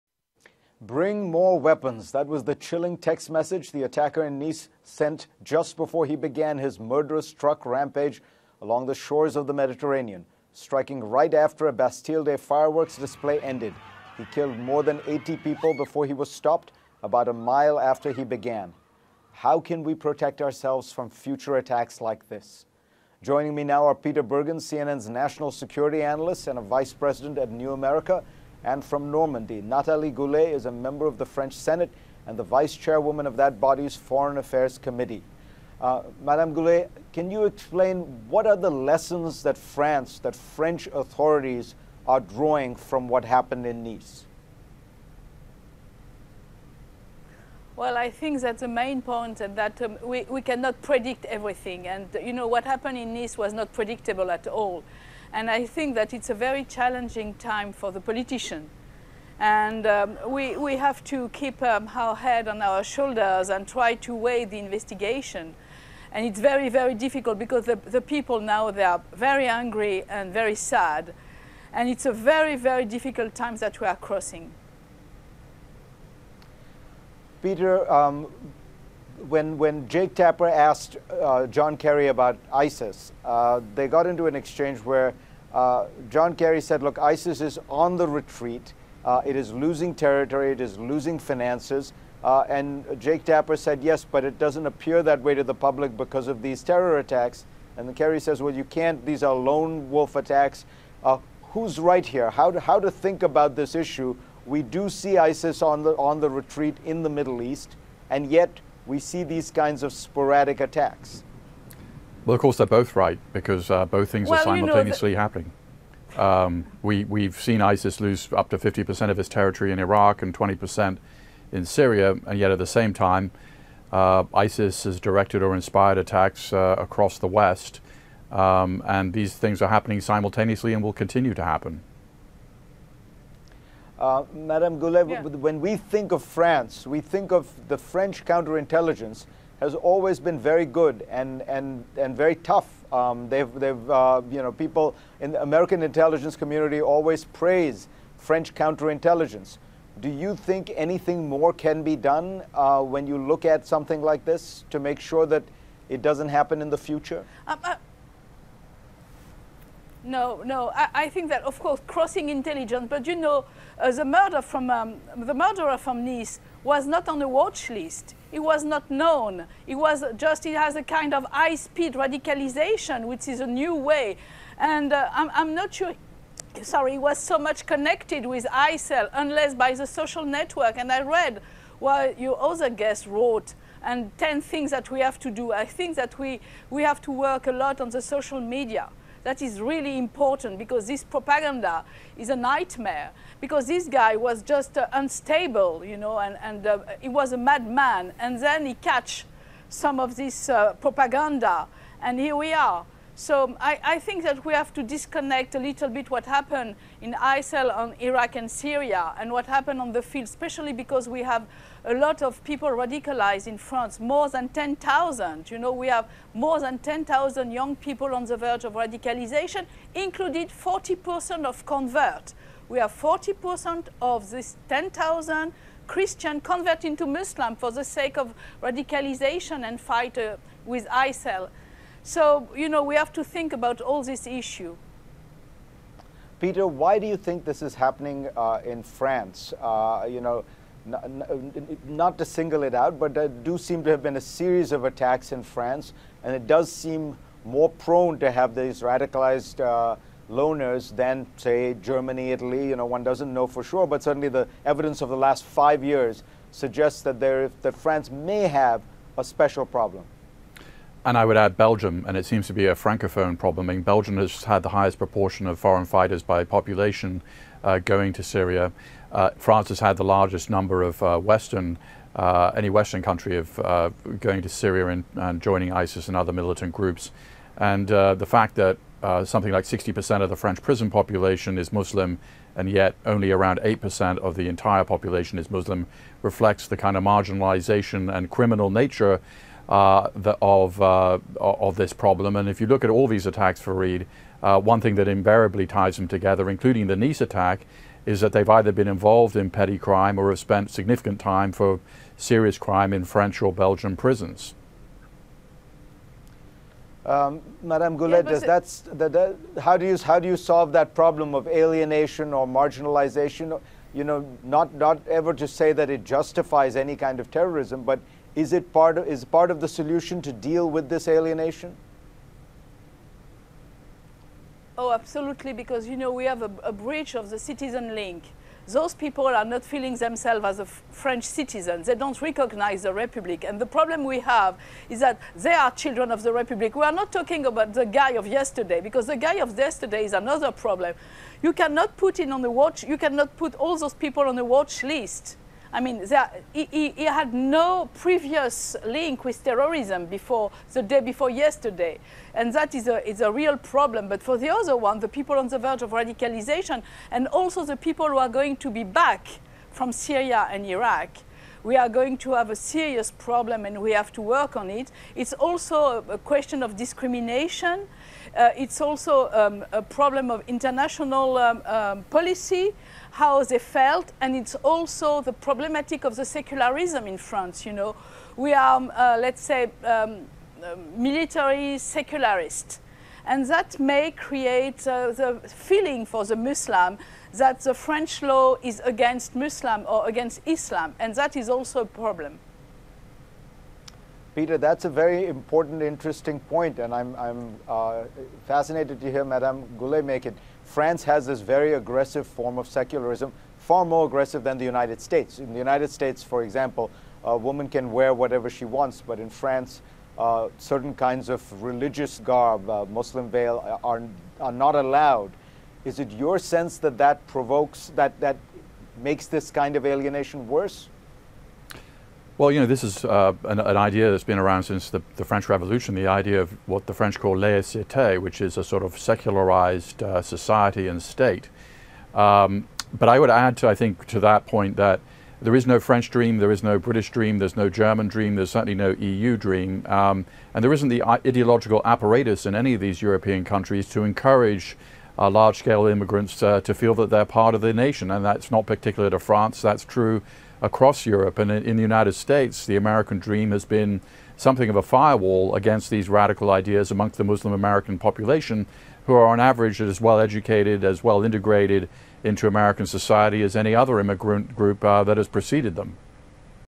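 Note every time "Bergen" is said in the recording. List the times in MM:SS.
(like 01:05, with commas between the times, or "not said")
00:24.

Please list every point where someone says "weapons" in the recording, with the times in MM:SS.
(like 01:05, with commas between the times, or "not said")
00:01.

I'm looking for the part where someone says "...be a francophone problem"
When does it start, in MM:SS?
04:22.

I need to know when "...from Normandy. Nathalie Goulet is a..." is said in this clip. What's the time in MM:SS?
00:28.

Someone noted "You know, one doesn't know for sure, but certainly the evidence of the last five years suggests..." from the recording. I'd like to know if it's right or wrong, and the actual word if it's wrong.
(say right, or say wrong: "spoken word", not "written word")
right.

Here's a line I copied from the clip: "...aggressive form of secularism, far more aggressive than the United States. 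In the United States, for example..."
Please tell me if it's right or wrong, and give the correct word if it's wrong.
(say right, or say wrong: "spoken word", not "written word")
right.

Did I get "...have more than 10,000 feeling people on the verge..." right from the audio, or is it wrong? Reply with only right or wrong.
wrong.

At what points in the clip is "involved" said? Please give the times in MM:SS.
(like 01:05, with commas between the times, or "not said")
04:58.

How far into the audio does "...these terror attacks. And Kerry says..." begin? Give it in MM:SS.
01:36.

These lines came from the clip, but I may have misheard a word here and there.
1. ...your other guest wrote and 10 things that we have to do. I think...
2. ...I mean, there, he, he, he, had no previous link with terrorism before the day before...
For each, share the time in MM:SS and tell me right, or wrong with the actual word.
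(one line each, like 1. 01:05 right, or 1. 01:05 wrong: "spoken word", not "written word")
1. 03:02 right
2. 05:45 right.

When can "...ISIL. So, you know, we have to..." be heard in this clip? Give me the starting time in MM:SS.
03:50.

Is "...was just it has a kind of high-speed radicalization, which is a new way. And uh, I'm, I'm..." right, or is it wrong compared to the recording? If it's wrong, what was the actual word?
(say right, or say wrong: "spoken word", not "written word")
right.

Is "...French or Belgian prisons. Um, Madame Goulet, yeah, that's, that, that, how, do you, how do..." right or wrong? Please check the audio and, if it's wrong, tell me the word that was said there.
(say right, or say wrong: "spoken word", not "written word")
right.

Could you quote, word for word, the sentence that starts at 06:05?
It's also a question of discrimination.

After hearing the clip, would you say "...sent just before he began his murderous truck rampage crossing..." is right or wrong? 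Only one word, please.
wrong.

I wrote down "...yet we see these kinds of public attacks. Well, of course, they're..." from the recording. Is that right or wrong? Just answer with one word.
wrong.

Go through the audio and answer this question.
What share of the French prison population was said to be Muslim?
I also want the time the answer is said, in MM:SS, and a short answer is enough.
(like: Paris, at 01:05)
60%, at 04:39.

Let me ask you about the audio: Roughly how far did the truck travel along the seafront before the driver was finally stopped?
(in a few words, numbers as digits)
About a mile.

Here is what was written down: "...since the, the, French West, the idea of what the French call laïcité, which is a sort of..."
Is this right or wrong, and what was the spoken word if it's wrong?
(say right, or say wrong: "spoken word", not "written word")
wrong: "Revolution", not "West".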